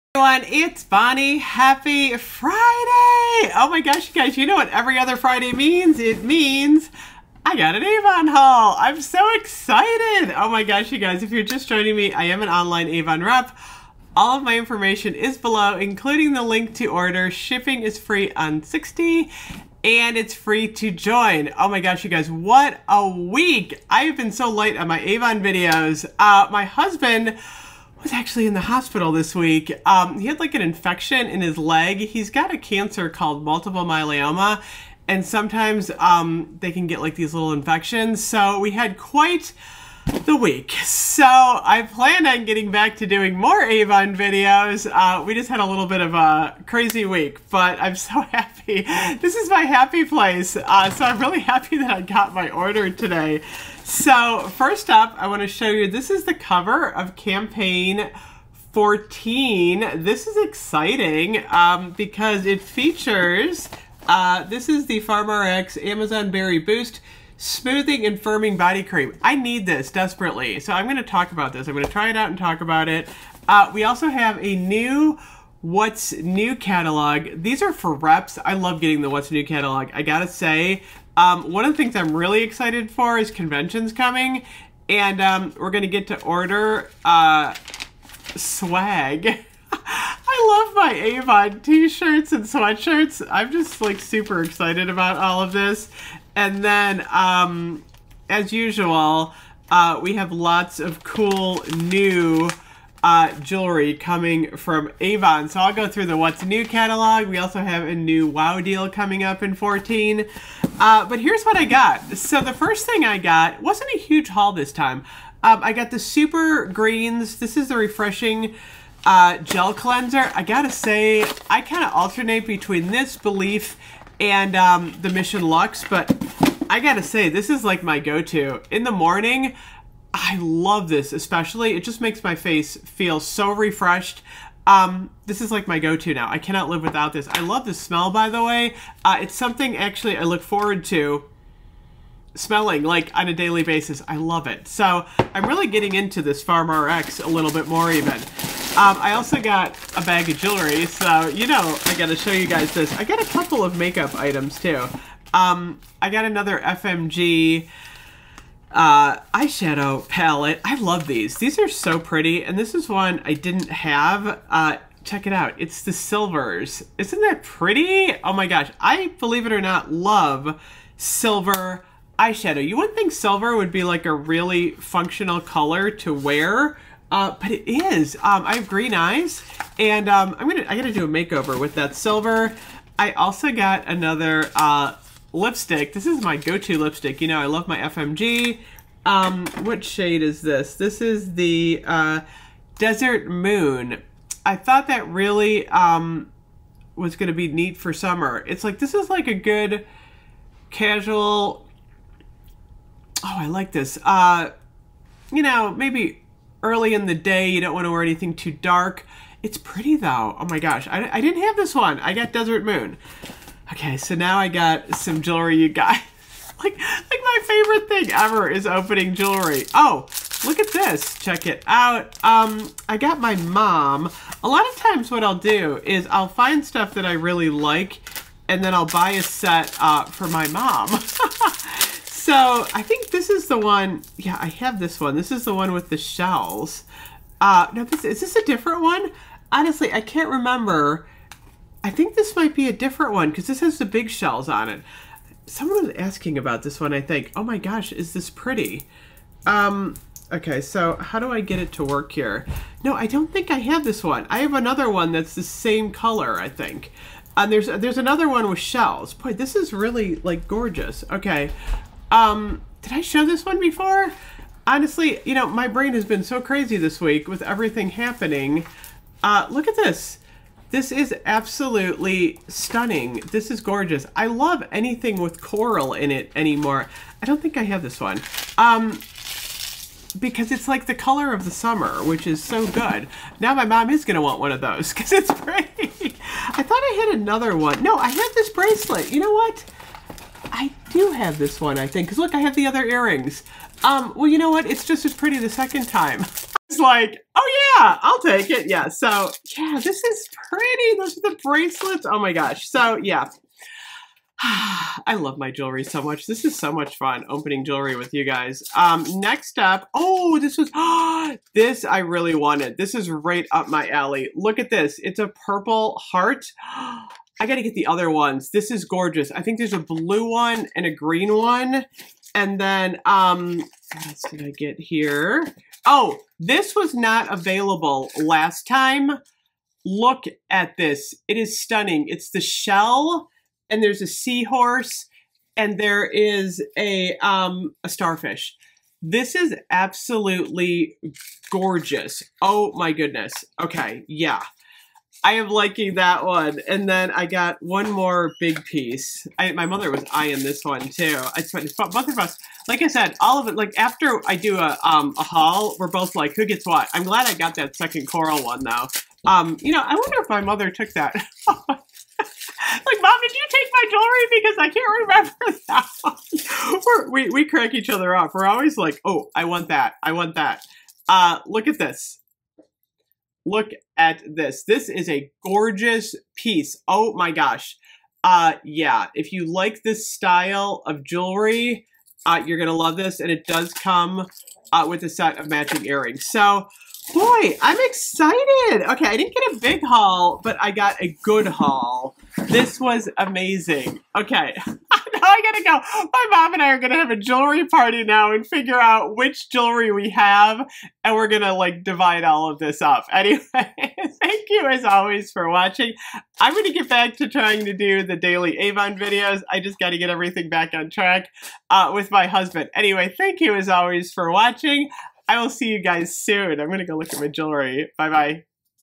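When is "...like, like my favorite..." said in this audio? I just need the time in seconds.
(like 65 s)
216 s.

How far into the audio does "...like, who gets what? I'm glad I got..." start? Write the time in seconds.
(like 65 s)
356 s.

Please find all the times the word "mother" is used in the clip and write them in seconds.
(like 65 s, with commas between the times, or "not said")
349 s, 360 s.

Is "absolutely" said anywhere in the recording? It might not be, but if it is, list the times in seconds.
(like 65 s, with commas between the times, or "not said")
271 s, 339 s.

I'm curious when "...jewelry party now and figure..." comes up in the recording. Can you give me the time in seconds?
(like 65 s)
397 s.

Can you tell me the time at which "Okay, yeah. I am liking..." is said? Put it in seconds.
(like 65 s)
343 s.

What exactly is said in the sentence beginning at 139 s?
Uh, it's something actually I look forward to smelling like on a daily basis.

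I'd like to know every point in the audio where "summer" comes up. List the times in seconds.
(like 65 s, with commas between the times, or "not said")
197 s, 281 s.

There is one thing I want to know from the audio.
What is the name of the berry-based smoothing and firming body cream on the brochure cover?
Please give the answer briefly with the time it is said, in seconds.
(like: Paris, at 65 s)
Amazon Berry Boost, at 65 s.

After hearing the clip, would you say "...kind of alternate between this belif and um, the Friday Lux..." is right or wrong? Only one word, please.
wrong.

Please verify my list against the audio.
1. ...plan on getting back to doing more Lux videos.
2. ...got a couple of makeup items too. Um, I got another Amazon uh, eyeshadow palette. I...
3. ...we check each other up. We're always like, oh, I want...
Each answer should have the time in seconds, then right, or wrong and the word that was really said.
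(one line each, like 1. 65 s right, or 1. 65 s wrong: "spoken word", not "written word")
1. 41 s wrong: "Avon", not "Lux"
2. 153 s wrong: "FMG", not "Amazon"
3. 367 s wrong: "crack", not "check".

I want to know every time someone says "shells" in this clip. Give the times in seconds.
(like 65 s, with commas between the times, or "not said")
235 s, 244 s, 258 s, 332 s.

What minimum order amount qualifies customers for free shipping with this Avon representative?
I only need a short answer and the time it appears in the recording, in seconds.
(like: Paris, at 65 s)
$60, at 18 s.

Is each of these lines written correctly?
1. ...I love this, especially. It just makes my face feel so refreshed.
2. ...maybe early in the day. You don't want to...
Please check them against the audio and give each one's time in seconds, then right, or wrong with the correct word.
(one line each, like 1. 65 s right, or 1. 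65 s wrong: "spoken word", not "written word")
1. 130 s right
2. 205 s right.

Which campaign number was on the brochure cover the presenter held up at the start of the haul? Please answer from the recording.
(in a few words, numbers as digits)
14.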